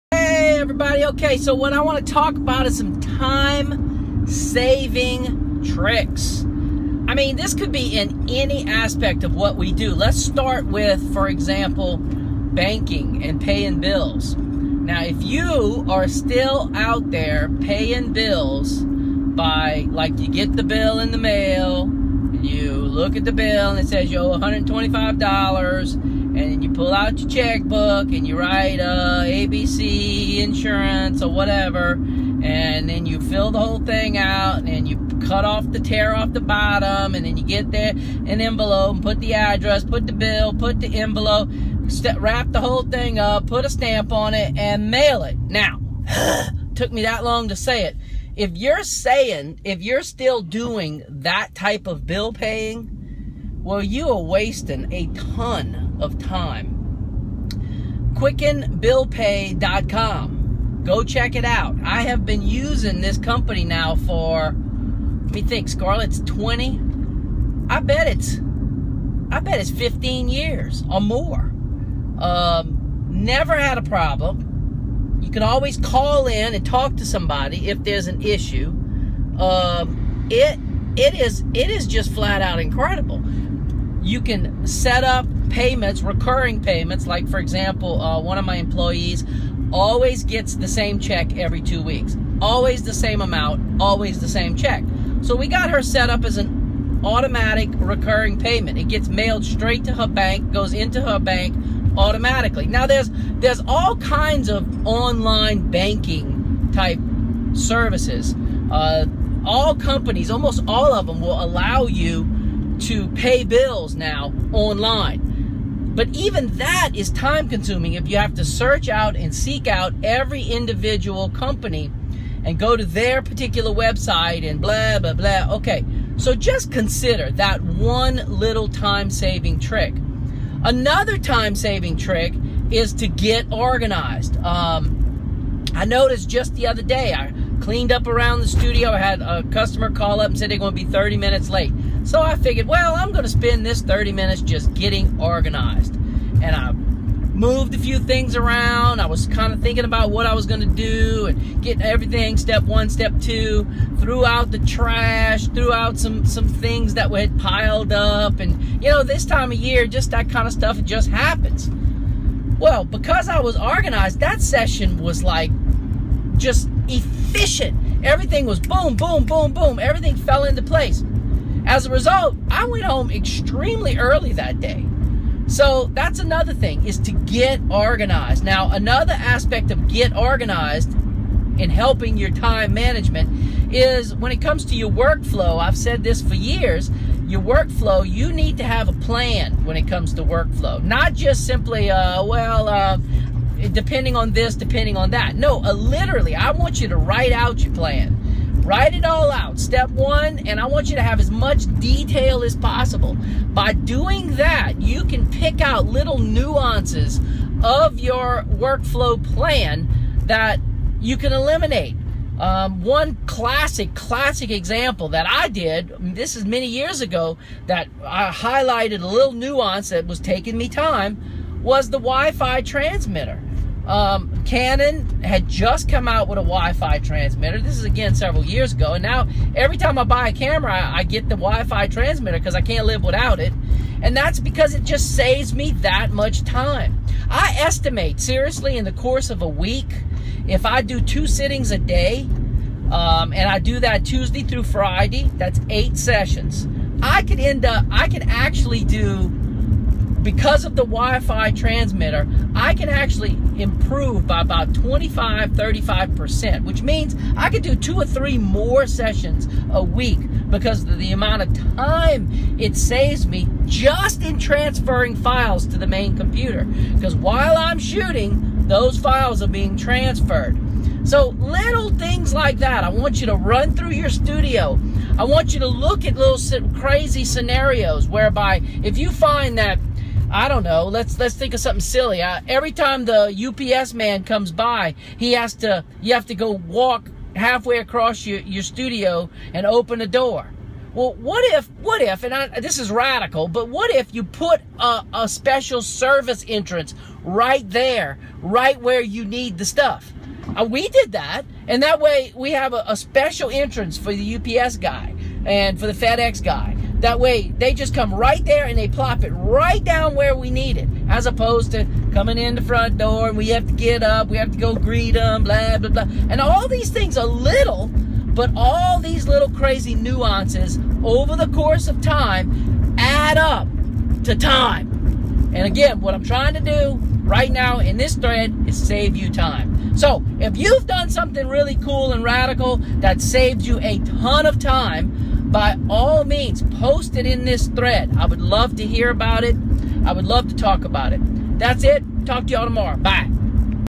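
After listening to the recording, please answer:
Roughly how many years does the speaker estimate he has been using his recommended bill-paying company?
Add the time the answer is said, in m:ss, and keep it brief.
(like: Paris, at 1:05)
15 years, at 1:09.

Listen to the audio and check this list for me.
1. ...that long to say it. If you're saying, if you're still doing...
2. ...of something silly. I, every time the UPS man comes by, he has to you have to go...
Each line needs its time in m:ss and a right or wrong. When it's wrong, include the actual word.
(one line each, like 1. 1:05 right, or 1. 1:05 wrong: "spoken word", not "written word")
1. 0:47 right
2. 4:41 right.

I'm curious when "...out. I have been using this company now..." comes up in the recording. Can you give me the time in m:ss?
1:01.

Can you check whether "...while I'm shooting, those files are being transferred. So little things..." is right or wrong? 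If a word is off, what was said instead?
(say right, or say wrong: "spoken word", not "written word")
right.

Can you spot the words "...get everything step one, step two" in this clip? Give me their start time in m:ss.
2:31.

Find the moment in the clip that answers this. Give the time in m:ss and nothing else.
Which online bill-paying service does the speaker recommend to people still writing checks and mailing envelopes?
0:58.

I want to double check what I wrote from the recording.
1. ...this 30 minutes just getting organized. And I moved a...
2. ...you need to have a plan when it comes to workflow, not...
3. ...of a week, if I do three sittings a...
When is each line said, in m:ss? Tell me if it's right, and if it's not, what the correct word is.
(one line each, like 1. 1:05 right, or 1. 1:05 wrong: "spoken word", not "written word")
1. 2:23 right
2. 3:08 right
3. 3:59 wrong: "two", not "three".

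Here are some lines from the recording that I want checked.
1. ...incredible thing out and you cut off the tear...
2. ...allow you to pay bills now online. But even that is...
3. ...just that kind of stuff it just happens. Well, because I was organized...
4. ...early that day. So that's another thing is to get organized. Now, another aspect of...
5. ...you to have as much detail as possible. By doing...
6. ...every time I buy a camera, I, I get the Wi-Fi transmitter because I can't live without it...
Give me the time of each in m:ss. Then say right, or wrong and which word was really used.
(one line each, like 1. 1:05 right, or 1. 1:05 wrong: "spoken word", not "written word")
1. 0:33 wrong: "whole", not "incredible"
2. 1:51 right
3. 2:39 right
4. 2:53 right
5. 3:20 right
6. 3:49 right.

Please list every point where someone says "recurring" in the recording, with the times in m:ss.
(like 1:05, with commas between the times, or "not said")
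1:26, 1:37.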